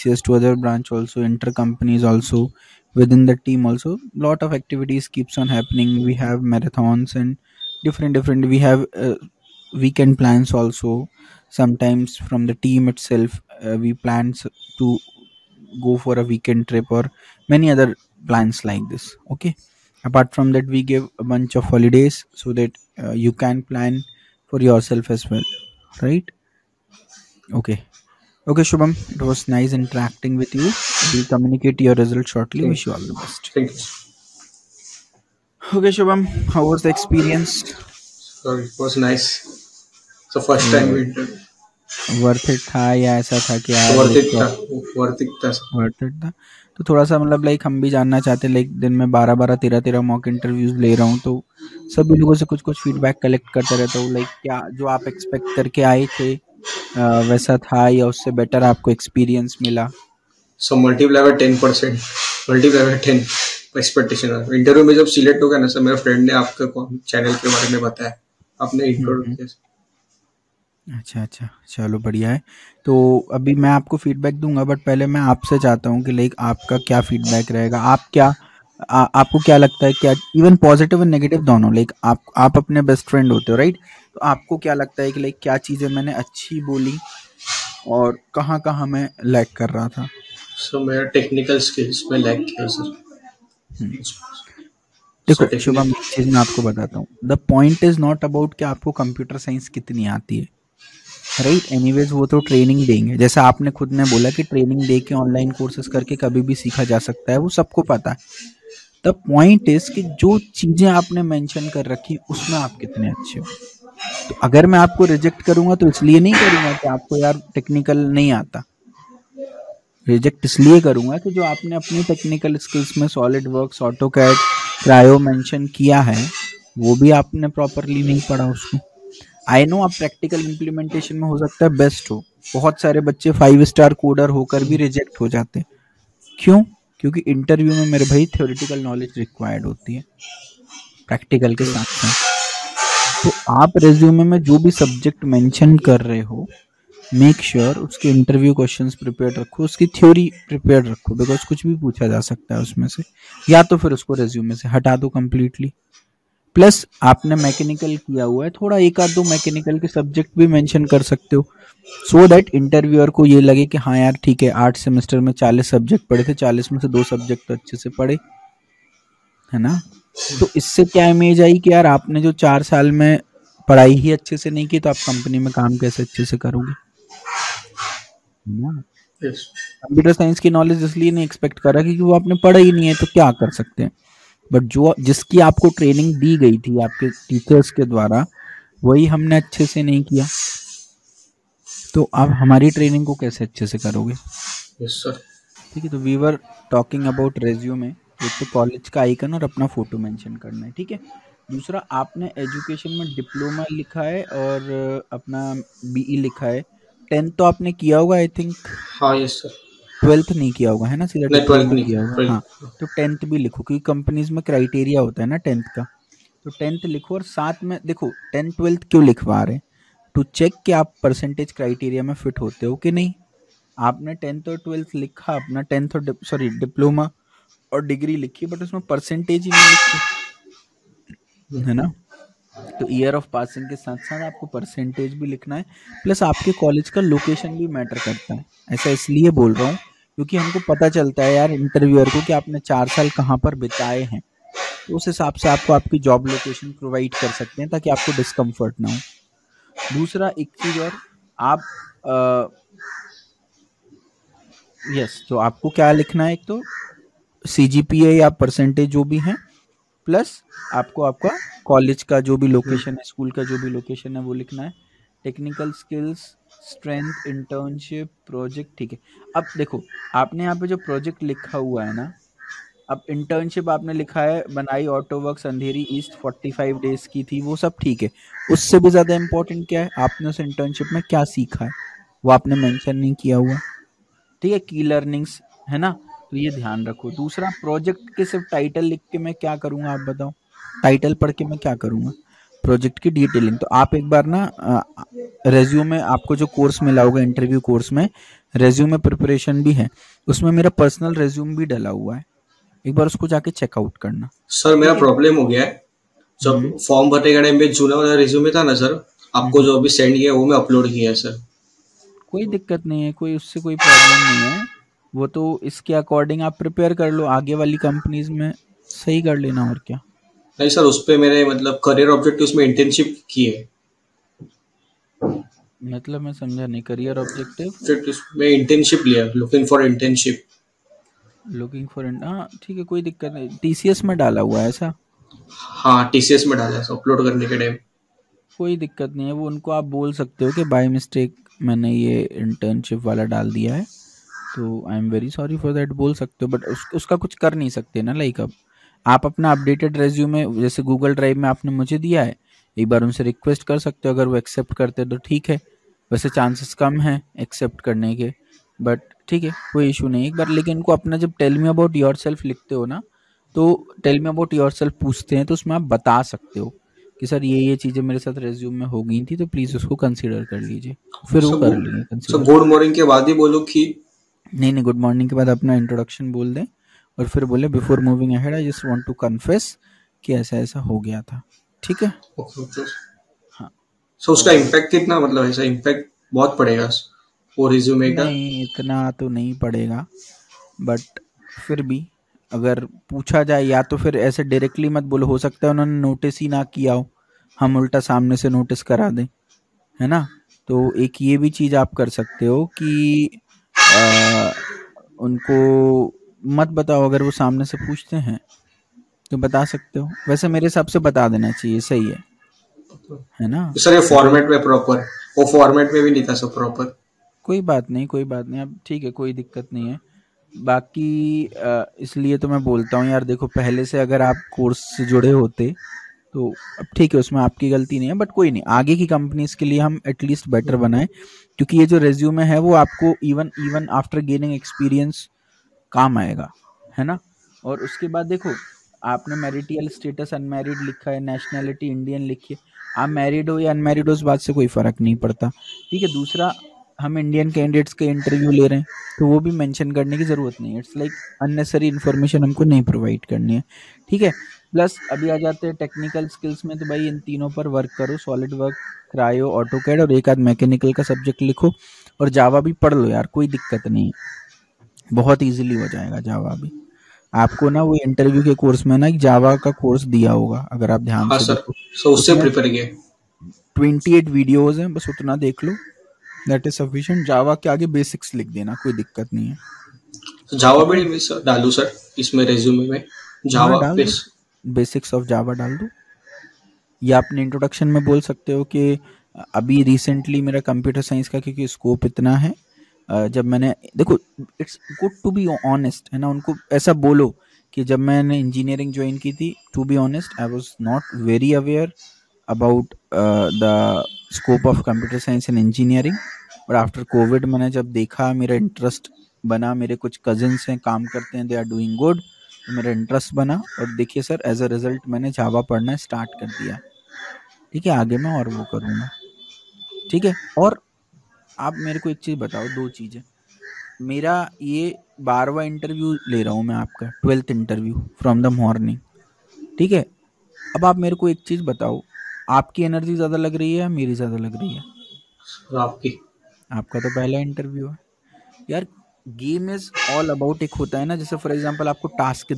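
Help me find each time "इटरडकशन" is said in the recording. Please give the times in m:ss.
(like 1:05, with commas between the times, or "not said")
6:15, 8:07.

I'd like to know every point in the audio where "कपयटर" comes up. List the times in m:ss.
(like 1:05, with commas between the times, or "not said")
1:39, 2:58, 8:10, 8:24.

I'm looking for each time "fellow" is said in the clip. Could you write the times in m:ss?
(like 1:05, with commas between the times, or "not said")
not said.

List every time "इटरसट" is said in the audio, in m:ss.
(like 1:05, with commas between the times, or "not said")
8:28, 8:32.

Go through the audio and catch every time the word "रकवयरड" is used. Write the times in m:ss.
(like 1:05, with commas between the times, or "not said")
2:19.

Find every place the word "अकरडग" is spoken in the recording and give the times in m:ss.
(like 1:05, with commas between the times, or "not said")
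5:15.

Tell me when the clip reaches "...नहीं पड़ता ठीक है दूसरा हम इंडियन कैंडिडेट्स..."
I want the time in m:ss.
7:25.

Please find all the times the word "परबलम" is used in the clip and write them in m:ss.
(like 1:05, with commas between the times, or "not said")
5:05, 5:13.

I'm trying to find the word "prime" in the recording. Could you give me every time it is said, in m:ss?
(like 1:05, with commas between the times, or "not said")
not said.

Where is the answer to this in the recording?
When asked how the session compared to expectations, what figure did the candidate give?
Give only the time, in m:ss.
1:01.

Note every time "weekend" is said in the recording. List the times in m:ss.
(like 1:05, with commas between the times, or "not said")
0:09, 0:16.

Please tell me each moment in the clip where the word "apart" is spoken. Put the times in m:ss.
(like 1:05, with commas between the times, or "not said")
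0:20.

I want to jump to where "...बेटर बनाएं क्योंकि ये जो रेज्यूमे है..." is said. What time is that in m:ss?
7:10.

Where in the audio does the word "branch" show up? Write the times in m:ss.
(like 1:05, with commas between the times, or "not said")
0:00.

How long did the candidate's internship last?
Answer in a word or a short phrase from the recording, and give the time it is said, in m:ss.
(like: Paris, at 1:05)
45 days, at 4:36.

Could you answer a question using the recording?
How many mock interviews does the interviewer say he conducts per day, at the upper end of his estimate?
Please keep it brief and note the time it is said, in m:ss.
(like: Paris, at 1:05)
13, at 0:49.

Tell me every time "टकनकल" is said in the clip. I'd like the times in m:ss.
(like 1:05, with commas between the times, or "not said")
1:31, 1:57, 2:02, 4:25, 7:35.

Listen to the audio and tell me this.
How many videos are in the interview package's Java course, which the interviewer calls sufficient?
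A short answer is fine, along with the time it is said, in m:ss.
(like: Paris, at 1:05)
28, at 7:53.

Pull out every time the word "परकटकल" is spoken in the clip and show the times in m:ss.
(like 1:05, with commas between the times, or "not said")
2:09, 2:21.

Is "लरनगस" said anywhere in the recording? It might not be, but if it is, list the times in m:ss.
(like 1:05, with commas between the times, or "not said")
4:44.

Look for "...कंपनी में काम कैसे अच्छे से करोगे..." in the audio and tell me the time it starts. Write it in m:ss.
2:55.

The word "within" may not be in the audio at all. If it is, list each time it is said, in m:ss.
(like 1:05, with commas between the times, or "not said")
0:02.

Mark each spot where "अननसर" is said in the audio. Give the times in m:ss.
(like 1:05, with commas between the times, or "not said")
7:31.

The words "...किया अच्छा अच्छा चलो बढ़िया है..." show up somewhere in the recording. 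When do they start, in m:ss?
1:09.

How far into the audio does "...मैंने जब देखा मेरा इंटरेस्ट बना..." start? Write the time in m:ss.
8:27.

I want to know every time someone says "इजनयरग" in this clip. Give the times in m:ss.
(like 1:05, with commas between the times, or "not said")
8:18, 8:25.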